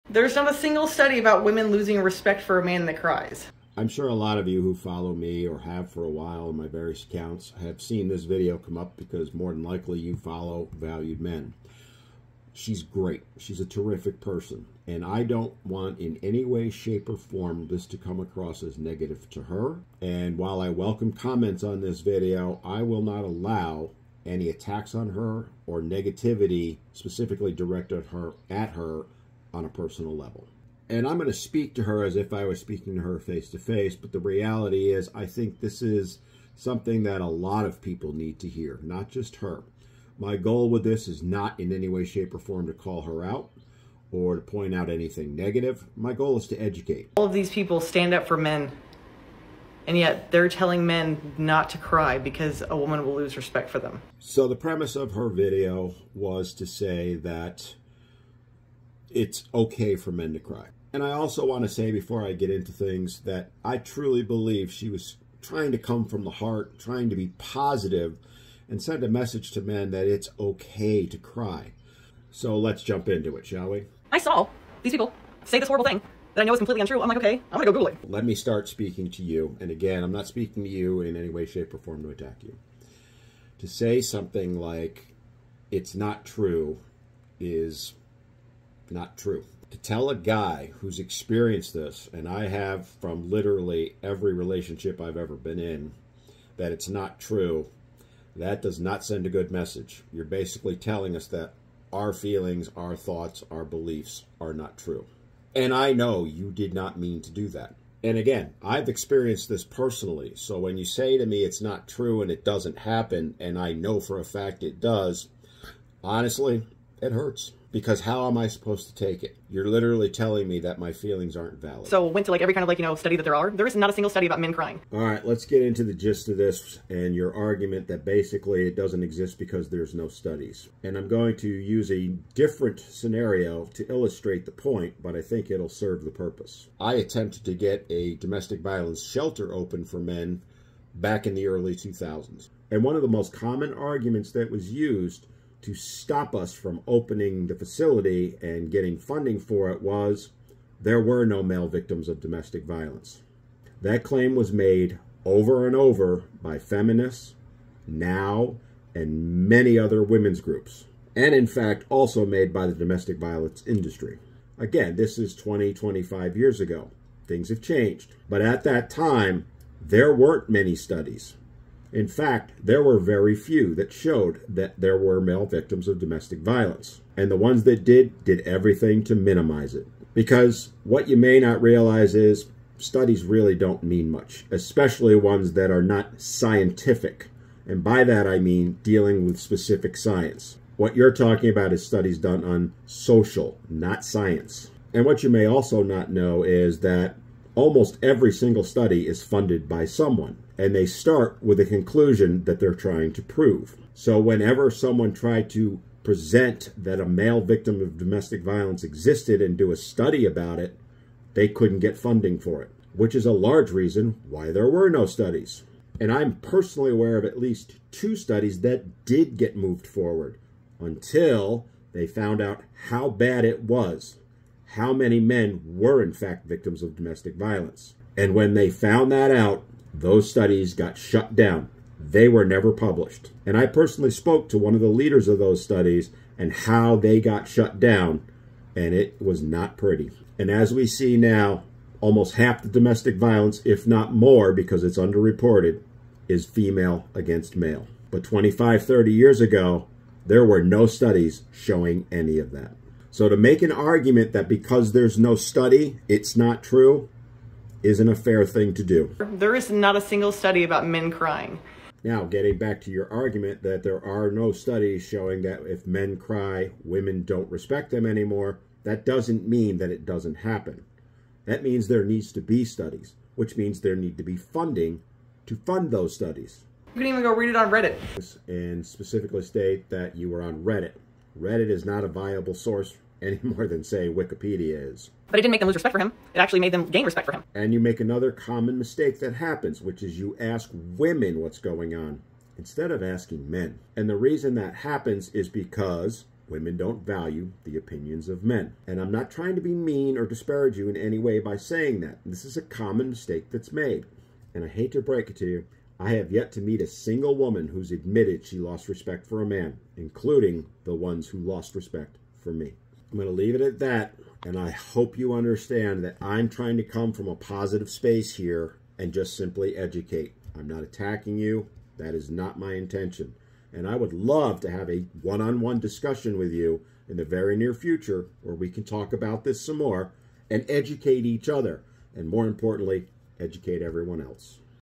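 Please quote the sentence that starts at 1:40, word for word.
You're basically telling us that our feelings, our thoughts, our beliefs are not true.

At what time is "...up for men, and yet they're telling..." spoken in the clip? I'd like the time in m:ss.
0:48.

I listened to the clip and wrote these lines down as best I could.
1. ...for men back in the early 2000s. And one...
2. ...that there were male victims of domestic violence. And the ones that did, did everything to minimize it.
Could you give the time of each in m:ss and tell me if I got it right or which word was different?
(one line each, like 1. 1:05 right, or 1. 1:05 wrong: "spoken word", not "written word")
1. 2:19 right
2. 2:54 right.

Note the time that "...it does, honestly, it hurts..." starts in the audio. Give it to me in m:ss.
1:54.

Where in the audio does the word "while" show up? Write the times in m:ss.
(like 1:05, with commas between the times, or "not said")
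0:06, 0:20.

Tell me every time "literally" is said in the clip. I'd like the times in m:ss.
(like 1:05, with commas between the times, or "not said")
1:33, 1:59.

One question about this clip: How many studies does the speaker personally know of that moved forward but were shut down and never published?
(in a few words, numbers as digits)
2.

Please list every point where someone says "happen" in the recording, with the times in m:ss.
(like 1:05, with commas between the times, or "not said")
1:52, 4:30, 4:49, 4:54.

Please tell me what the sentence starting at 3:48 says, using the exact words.
And when they found that out, those studies got shut down.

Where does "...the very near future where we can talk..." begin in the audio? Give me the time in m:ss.
5:27.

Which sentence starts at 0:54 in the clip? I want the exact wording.
So the premise of her video was to say that it's okay for men to cry.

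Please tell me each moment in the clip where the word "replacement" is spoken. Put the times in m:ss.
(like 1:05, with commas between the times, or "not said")
not said.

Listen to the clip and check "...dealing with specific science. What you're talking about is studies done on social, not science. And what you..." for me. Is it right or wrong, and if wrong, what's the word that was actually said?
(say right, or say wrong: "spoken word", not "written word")
right.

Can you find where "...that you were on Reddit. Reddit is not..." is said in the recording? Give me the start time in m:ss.
4:39.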